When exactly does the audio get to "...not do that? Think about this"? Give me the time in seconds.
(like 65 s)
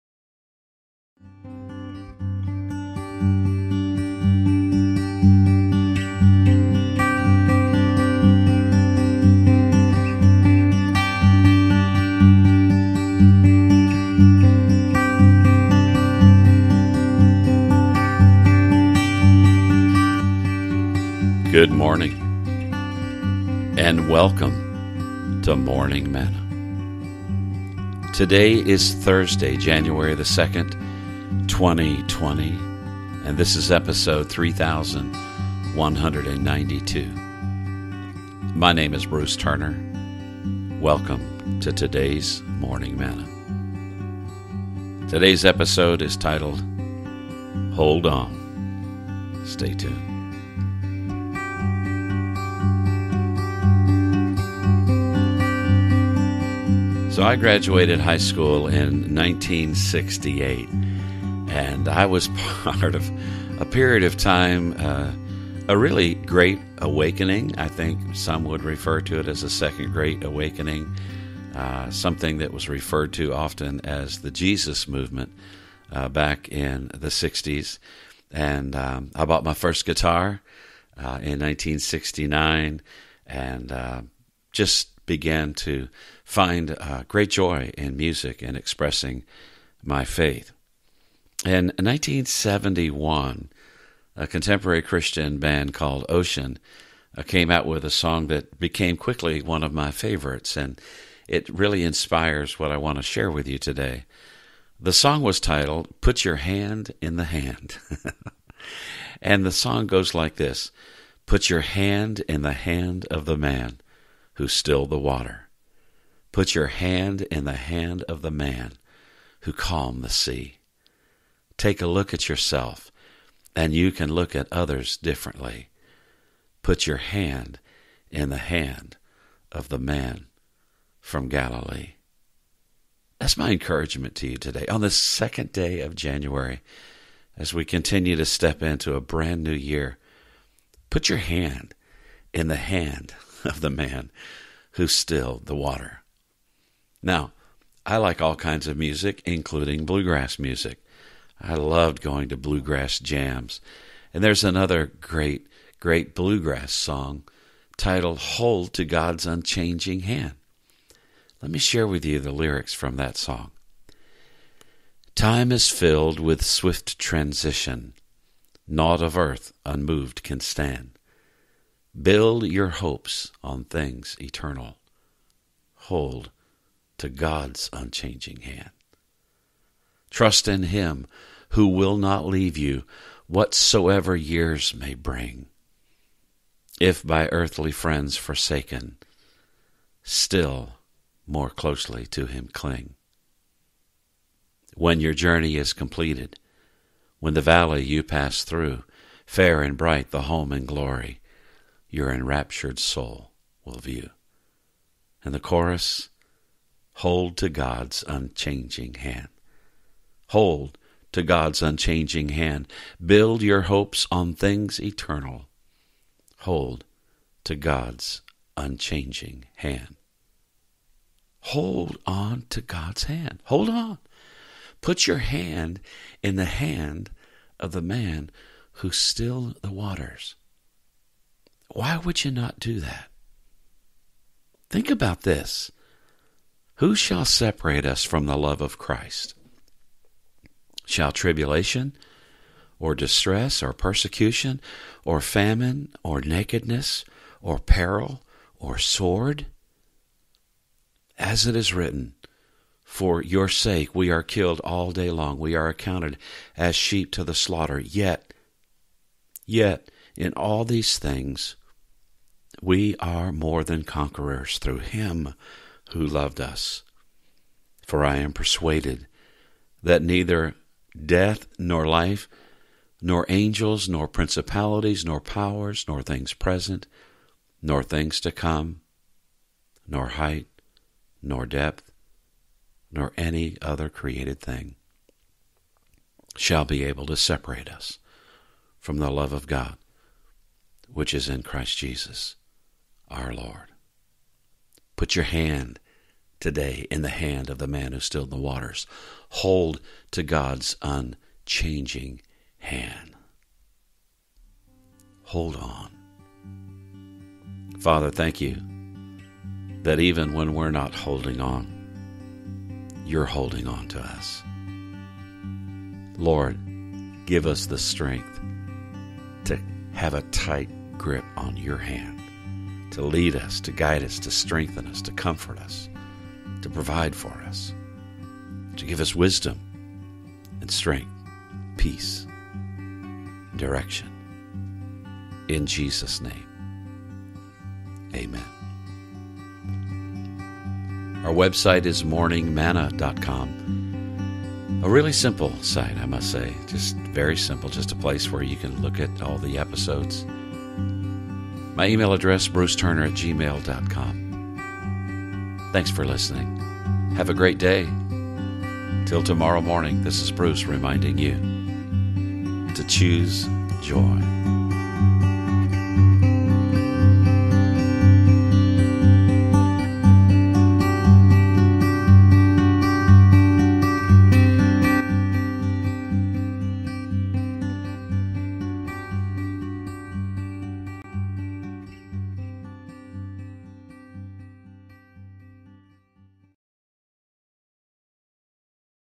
232 s.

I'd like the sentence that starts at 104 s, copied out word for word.
The song was titled Put Your Hand in the Hand.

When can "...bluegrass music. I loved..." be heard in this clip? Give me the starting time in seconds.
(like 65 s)
149 s.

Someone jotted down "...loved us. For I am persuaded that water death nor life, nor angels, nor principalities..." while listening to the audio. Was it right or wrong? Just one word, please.
wrong.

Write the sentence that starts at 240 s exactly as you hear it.
Shall tribulation, or distress, or persecution, or famine, or nakedness, or peril, or sword?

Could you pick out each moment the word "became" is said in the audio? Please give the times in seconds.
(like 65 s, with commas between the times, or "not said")
98 s.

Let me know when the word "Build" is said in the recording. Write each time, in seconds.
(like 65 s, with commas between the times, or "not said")
171 s, 213 s.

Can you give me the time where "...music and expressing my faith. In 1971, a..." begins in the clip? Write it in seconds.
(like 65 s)
87 s.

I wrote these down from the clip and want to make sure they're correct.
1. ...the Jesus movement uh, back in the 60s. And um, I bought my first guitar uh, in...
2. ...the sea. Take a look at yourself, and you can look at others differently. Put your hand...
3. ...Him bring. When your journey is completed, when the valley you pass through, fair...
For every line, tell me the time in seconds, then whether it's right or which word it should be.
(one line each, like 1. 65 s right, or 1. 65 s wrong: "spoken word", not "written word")
1. 74 s right
2. 120 s right
3. 192 s wrong: "cling", not "bring".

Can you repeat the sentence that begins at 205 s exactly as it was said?
And the chorus Hold to God's unchanging hand.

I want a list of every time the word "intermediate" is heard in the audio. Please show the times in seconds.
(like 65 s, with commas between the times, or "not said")
not said.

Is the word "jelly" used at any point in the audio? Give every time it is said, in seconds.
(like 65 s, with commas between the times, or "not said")
not said.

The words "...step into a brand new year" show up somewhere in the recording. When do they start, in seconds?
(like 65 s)
138 s.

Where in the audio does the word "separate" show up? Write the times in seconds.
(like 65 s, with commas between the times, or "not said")
237 s, 287 s.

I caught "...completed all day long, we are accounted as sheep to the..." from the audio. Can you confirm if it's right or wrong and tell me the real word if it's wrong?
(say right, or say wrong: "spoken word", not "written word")
wrong: "killed", not "completed".